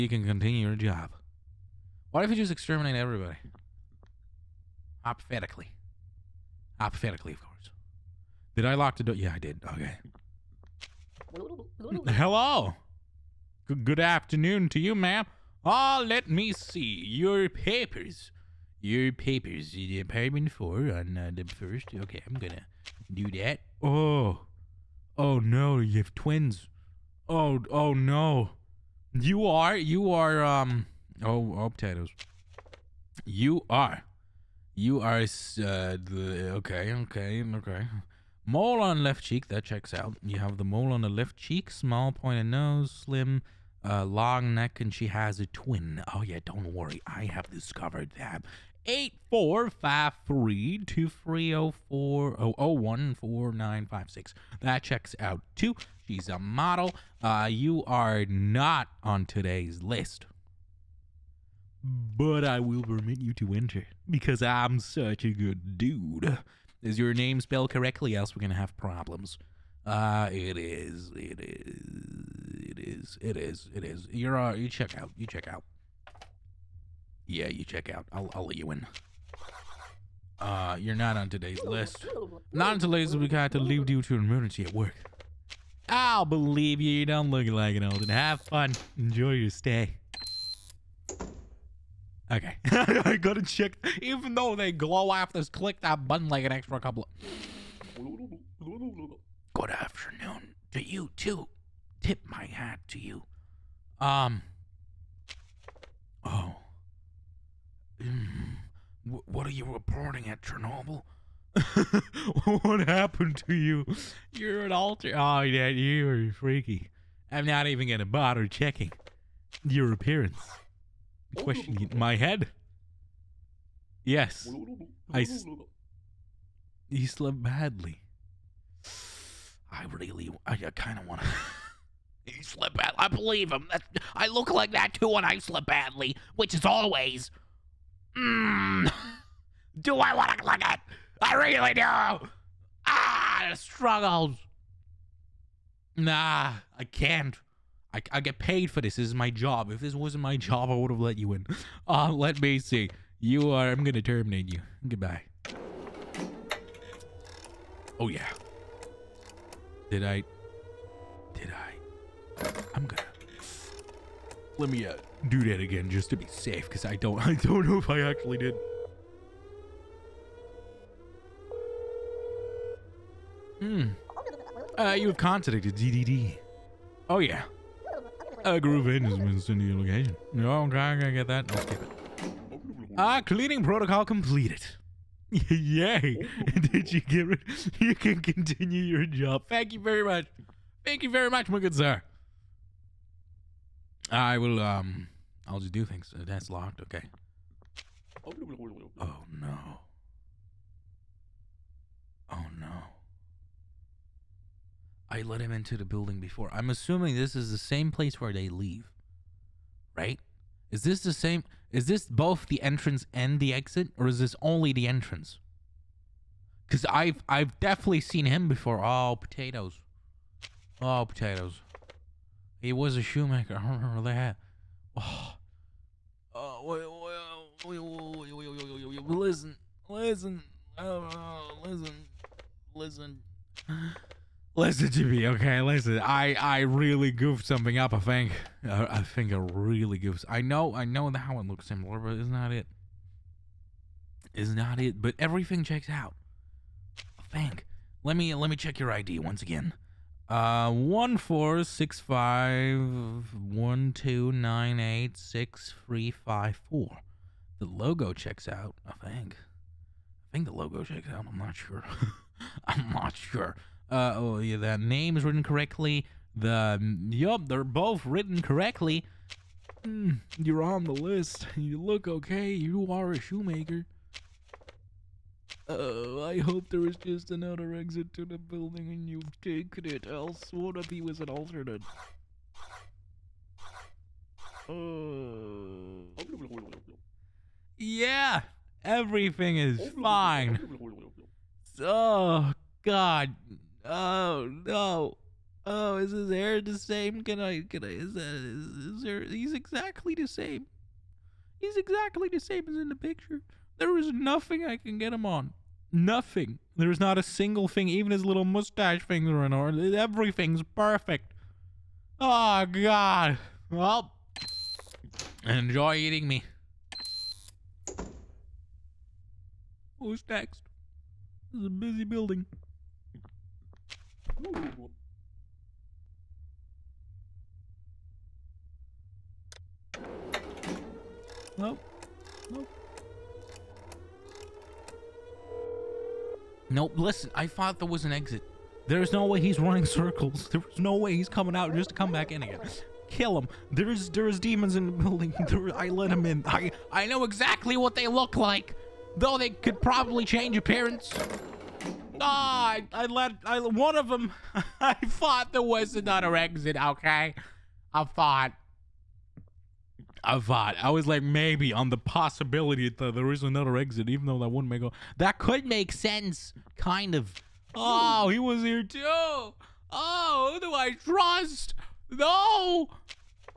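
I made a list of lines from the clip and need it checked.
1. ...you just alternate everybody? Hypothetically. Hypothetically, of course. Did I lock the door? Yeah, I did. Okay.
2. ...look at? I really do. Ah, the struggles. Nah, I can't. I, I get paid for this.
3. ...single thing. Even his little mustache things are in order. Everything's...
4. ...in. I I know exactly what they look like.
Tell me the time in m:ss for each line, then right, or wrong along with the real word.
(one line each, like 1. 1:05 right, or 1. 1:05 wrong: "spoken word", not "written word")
1. 0:02 wrong: "exterminate", not "alternate"
2. 2:20 right
3. 5:07 right
4. 5:46 right.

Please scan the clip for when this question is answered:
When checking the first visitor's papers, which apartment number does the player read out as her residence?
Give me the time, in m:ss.
0:19.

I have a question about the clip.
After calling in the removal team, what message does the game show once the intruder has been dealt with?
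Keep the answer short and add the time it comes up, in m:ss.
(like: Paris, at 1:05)
Cleaning protocol completed, at 3:03.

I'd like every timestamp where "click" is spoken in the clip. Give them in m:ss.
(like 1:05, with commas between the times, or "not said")
1:35.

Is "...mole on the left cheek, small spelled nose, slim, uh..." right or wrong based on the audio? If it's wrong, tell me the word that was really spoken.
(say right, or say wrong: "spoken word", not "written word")
wrong: "pointed", not "spelled".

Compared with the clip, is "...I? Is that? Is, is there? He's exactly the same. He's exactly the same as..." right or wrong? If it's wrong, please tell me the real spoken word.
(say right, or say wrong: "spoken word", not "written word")
right.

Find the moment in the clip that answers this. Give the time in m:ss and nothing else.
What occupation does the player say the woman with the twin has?
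0:56.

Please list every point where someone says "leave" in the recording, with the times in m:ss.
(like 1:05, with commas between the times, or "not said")
1:23, 3:28.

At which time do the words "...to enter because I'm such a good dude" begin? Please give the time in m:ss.
1:03.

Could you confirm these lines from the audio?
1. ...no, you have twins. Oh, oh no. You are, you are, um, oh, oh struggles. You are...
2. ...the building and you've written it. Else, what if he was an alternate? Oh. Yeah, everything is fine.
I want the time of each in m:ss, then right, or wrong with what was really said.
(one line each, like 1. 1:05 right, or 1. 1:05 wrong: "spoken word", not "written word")
1. 0:25 wrong: "potatoes", not "struggles"
2. 4:38 wrong: "taken", not "written".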